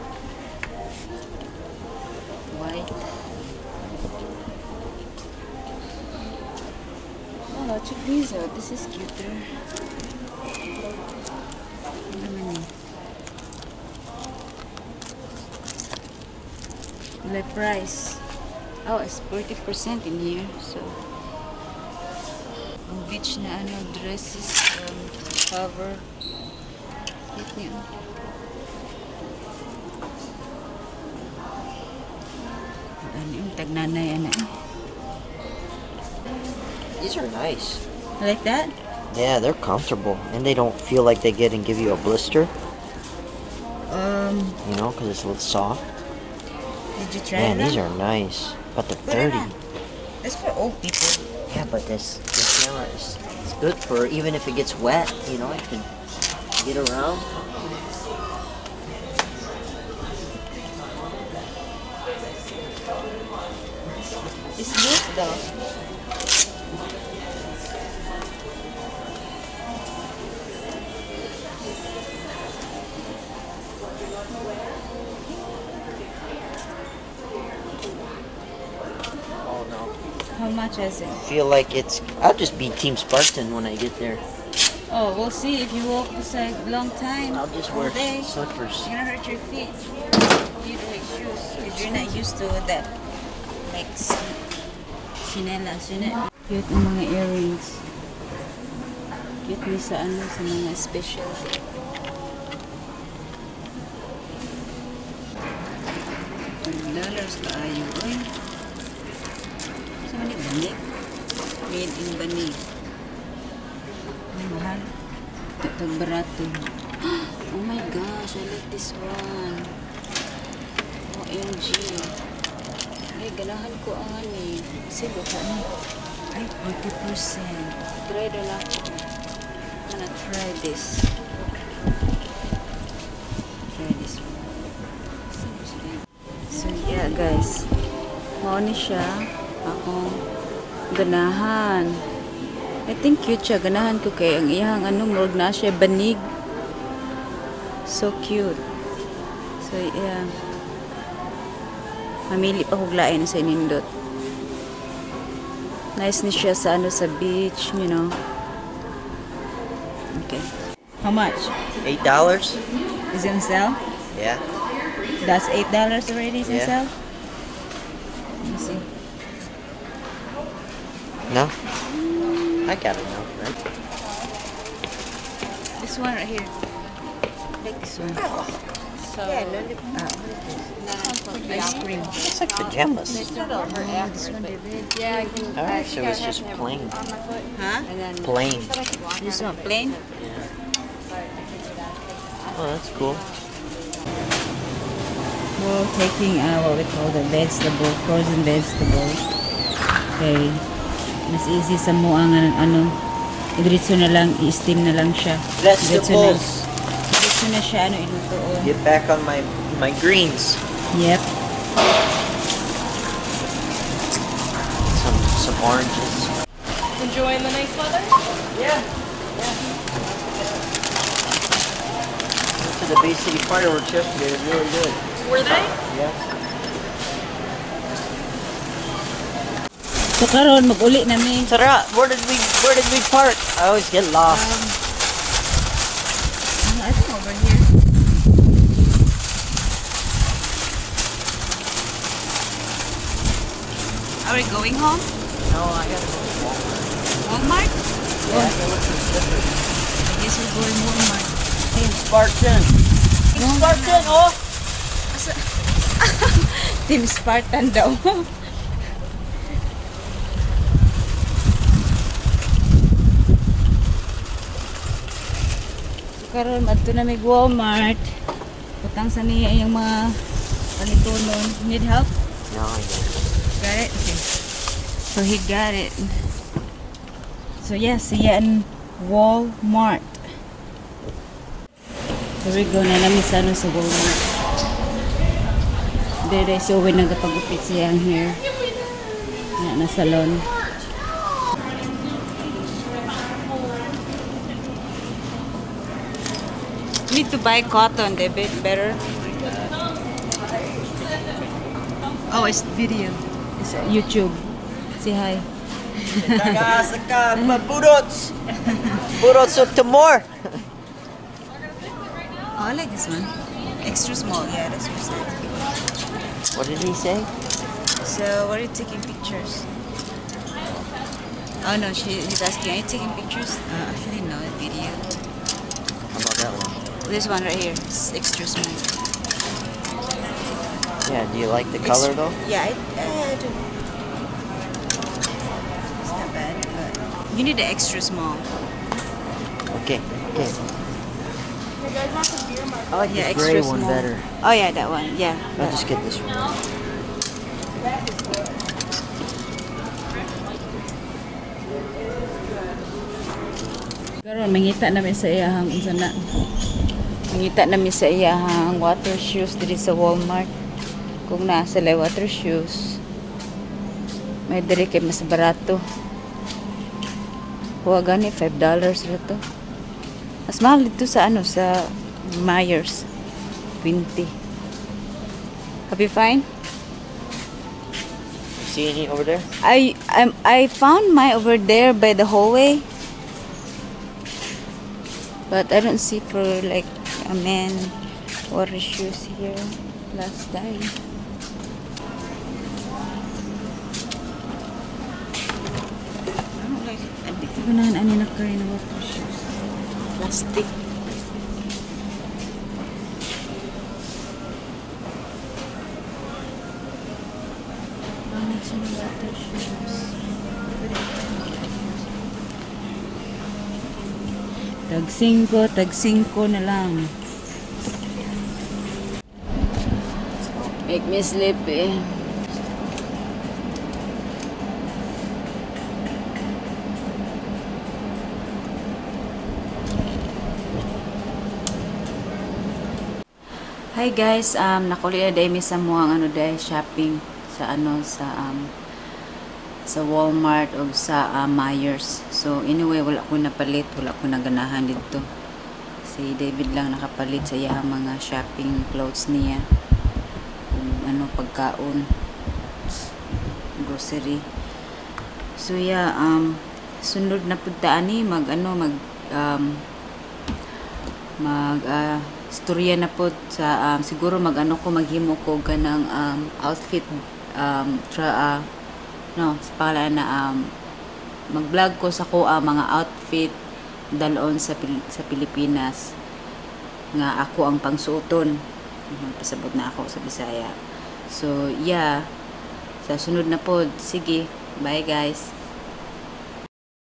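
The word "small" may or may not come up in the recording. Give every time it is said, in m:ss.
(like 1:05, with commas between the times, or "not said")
5:14, 5:28, 5:38, 5:43.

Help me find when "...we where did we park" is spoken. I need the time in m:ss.
3:52.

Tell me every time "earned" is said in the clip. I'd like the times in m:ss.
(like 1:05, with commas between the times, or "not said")
not said.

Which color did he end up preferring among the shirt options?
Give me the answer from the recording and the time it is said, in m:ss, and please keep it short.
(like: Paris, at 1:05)
Gray, at 5:43.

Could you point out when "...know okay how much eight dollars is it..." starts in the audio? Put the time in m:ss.
2:37.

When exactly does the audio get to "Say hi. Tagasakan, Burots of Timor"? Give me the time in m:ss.
5:05.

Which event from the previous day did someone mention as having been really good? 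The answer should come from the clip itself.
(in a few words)
BC fireworks.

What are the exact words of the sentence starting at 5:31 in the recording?
Yeah, do you like the color though?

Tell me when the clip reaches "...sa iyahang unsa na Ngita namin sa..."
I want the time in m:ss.
5:55.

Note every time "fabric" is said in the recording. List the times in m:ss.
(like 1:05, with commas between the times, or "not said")
not said.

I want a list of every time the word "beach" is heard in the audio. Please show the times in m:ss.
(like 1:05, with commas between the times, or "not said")
0:23, 2:37.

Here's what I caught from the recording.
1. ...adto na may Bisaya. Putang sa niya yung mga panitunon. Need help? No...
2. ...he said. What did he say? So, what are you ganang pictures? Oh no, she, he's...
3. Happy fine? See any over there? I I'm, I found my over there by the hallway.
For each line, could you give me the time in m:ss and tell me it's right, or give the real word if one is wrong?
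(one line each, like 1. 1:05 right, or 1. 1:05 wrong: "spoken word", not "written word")
1. 4:26 wrong: "Walmart", not "Bisaya"
2. 5:14 wrong: "taking", not "ganang"
3. 6:15 right.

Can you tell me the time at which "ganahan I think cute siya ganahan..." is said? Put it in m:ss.
2:20.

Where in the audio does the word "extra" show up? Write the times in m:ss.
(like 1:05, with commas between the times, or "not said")
5:13, 5:28, 5:37.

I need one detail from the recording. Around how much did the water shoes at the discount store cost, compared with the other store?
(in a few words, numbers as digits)
$5.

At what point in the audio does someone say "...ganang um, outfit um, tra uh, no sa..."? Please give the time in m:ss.
7:45.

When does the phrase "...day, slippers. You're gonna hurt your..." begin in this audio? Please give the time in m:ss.
1:27.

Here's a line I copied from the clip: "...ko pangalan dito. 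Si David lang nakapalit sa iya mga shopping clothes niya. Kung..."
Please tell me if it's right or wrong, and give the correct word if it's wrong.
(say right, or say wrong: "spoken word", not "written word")
wrong: "naganahan", not "pangalan".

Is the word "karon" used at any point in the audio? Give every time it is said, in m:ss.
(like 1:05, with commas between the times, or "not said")
3:50, 4:26, 5:54.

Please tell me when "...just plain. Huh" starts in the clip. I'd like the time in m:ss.
3:06.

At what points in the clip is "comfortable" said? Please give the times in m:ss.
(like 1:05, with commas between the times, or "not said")
0:39.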